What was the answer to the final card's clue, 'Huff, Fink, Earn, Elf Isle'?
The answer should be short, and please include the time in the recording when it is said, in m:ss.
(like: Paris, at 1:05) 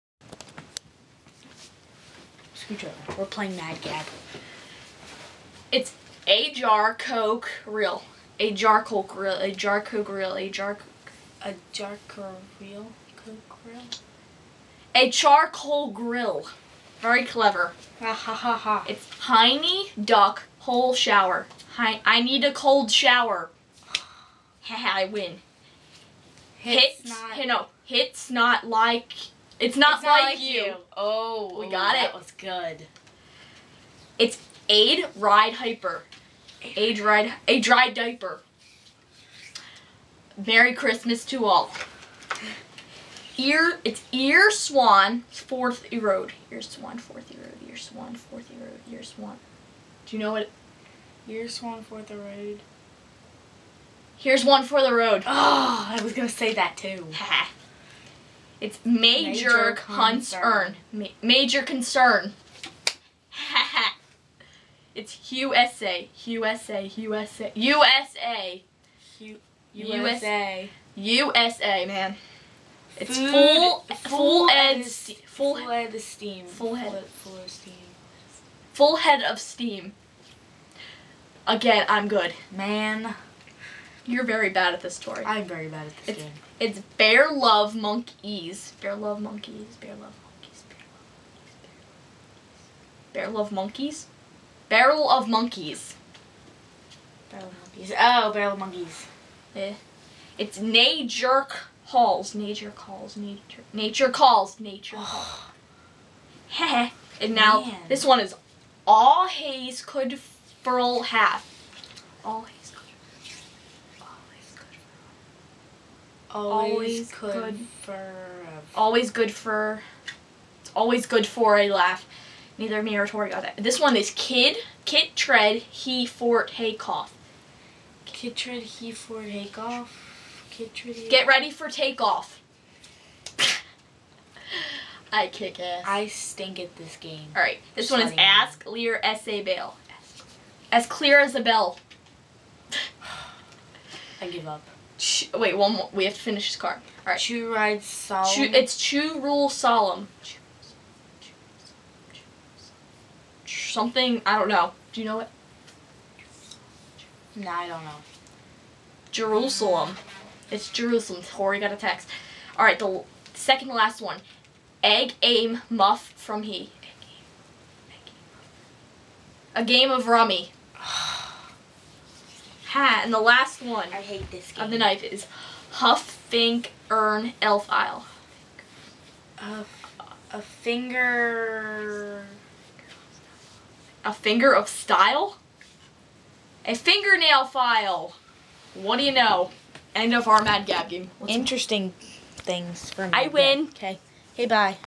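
a fingernail file, at 3:06.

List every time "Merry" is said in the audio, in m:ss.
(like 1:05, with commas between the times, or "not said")
0:40.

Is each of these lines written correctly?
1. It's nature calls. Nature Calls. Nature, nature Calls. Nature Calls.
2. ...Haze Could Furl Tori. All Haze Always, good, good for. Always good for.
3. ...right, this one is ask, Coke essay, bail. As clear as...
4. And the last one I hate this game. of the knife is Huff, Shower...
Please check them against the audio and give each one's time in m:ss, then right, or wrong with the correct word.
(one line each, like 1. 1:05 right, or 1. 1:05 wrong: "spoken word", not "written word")
1. 1:40 right
2. 1:49 wrong: "Half", not "Tori"
3. 2:17 wrong: "Lear", not "Coke"
4. 2:53 wrong: "Fink", not "Shower".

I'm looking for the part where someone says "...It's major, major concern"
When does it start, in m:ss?
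0:58.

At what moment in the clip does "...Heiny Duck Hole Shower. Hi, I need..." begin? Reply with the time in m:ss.
0:19.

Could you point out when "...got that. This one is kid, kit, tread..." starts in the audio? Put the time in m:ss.
2:03.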